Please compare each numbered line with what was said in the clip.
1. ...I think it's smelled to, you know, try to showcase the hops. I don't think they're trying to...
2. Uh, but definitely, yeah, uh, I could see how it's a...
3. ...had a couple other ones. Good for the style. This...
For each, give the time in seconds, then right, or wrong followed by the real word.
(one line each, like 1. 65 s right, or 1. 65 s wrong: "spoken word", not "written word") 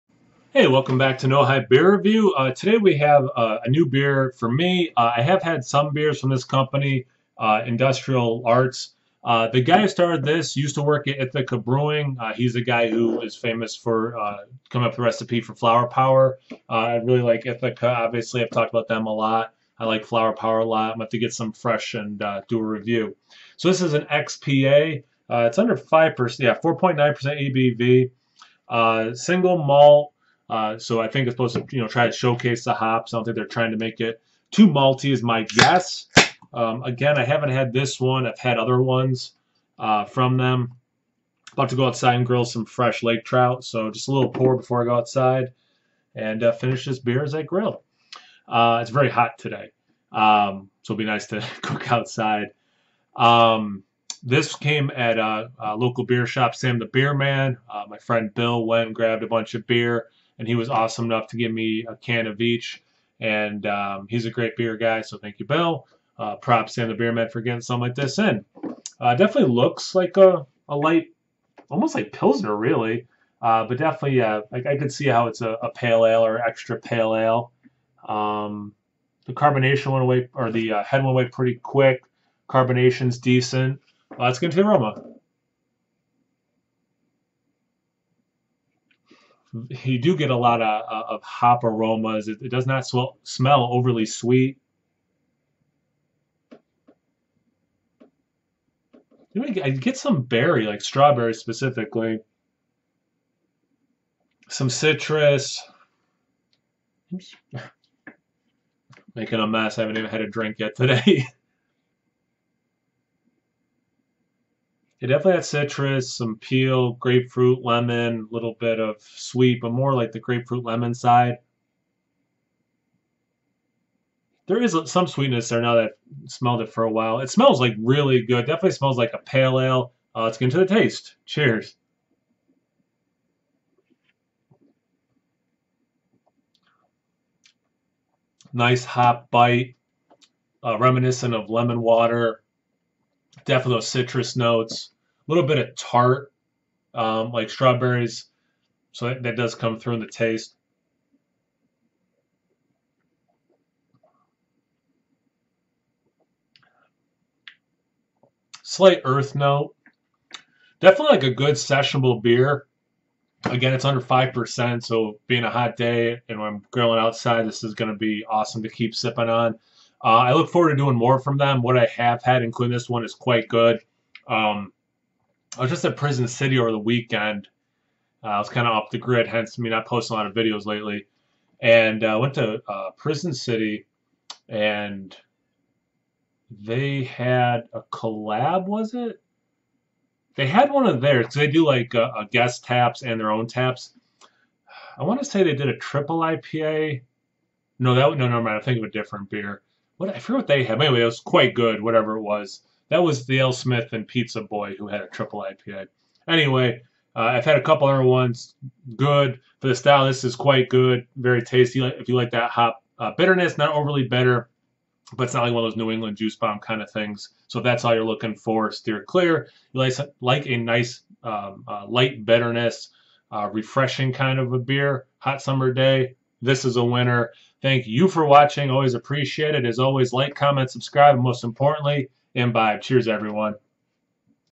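1. 30 s wrong: "supposed", not "smelled"
2. 73 s right
3. 207 s right.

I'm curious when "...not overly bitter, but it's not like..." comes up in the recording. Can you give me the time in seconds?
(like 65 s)
213 s.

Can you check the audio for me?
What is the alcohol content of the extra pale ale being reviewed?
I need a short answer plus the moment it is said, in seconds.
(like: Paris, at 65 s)
4.9% ABV, at 26 s.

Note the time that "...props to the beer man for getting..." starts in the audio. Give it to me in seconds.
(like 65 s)
66 s.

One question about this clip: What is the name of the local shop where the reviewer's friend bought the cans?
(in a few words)
Sam the Beer Man.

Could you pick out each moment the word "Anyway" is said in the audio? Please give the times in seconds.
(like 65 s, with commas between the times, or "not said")
200 s, 206 s.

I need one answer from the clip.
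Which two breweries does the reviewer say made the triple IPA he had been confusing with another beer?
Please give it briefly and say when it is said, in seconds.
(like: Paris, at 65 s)
AleSmith and Pizza Boy, at 203 s.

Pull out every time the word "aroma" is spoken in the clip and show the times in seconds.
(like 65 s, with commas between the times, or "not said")
84 s, 91 s.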